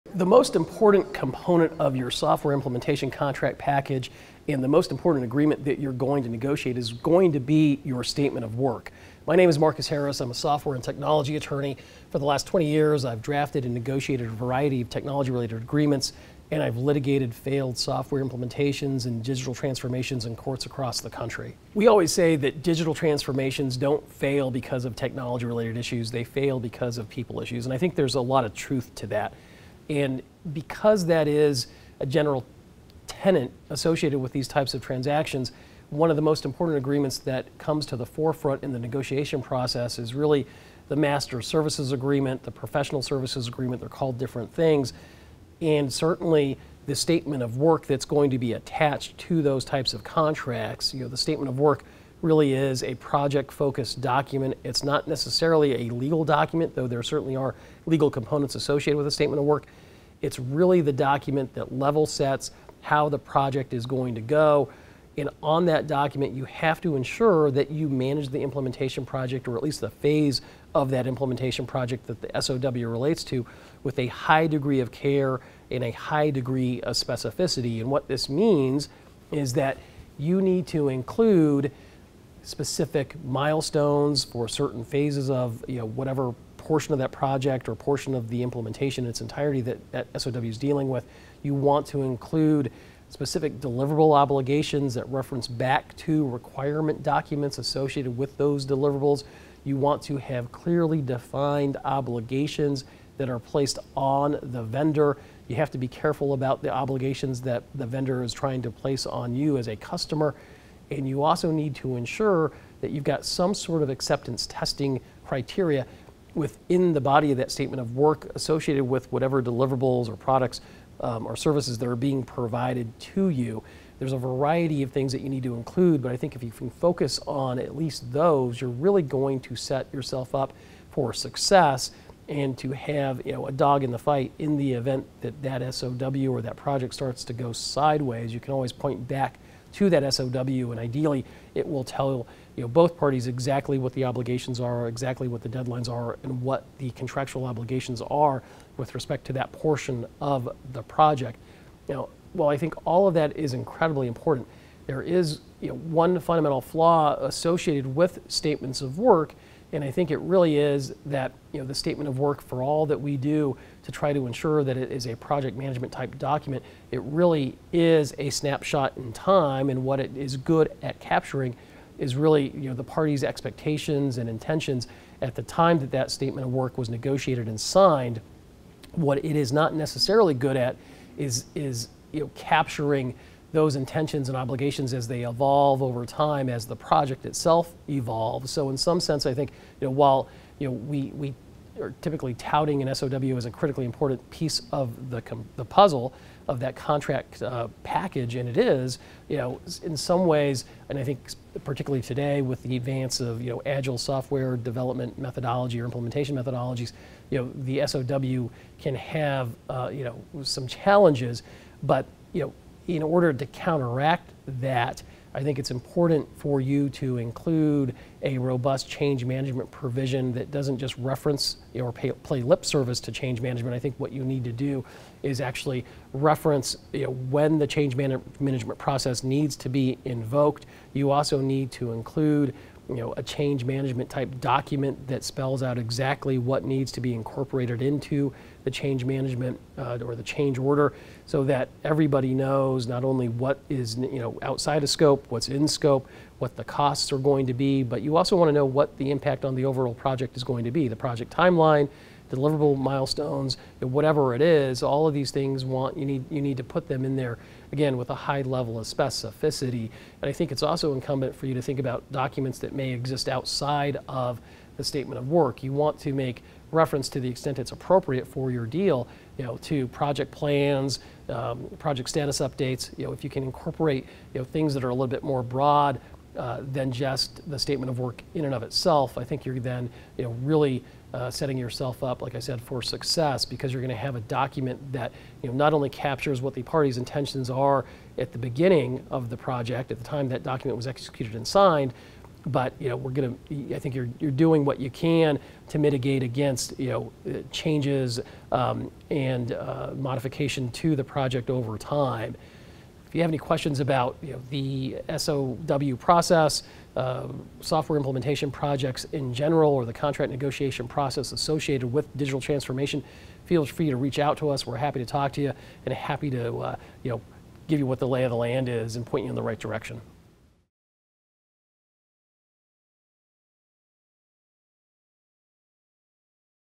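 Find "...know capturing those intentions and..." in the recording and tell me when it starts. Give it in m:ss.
3:02.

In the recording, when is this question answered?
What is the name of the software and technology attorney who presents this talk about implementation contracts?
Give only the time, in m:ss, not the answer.
0:09.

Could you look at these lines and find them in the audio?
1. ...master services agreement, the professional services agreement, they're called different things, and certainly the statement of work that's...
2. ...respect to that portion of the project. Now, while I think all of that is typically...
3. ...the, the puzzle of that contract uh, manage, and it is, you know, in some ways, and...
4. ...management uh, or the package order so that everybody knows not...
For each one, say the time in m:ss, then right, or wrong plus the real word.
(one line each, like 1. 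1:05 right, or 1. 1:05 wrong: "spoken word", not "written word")
1. 0:40 right
2. 2:28 wrong: "incredibly", not "typically"
3. 3:15 wrong: "package", not "manage"
4. 3:59 wrong: "change", not "package".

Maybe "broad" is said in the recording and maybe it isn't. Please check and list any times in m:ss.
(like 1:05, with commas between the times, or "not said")
4:35.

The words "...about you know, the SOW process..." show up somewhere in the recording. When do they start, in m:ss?
5:03.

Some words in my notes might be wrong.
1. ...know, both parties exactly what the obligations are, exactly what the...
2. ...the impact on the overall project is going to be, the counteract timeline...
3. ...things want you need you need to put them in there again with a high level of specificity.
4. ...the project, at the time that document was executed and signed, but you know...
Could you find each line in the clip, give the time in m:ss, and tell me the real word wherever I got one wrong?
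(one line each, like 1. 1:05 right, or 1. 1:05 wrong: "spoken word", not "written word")
1. 2:22 right
2. 4:08 wrong: "project", not "counteract"
3. 4:15 right
4. 4:49 right.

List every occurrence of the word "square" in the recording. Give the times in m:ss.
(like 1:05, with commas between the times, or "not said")
not said.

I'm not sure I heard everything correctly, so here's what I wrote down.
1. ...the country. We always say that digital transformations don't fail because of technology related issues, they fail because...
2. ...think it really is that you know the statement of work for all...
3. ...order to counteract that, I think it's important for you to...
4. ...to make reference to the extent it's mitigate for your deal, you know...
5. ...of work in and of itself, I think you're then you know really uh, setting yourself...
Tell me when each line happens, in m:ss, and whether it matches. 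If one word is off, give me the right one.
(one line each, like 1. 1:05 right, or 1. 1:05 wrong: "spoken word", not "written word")
1. 0:20 right
2. 2:39 right
3. 3:33 right
4. 4:25 wrong: "appropriate", not "mitigate"
5. 4:37 right.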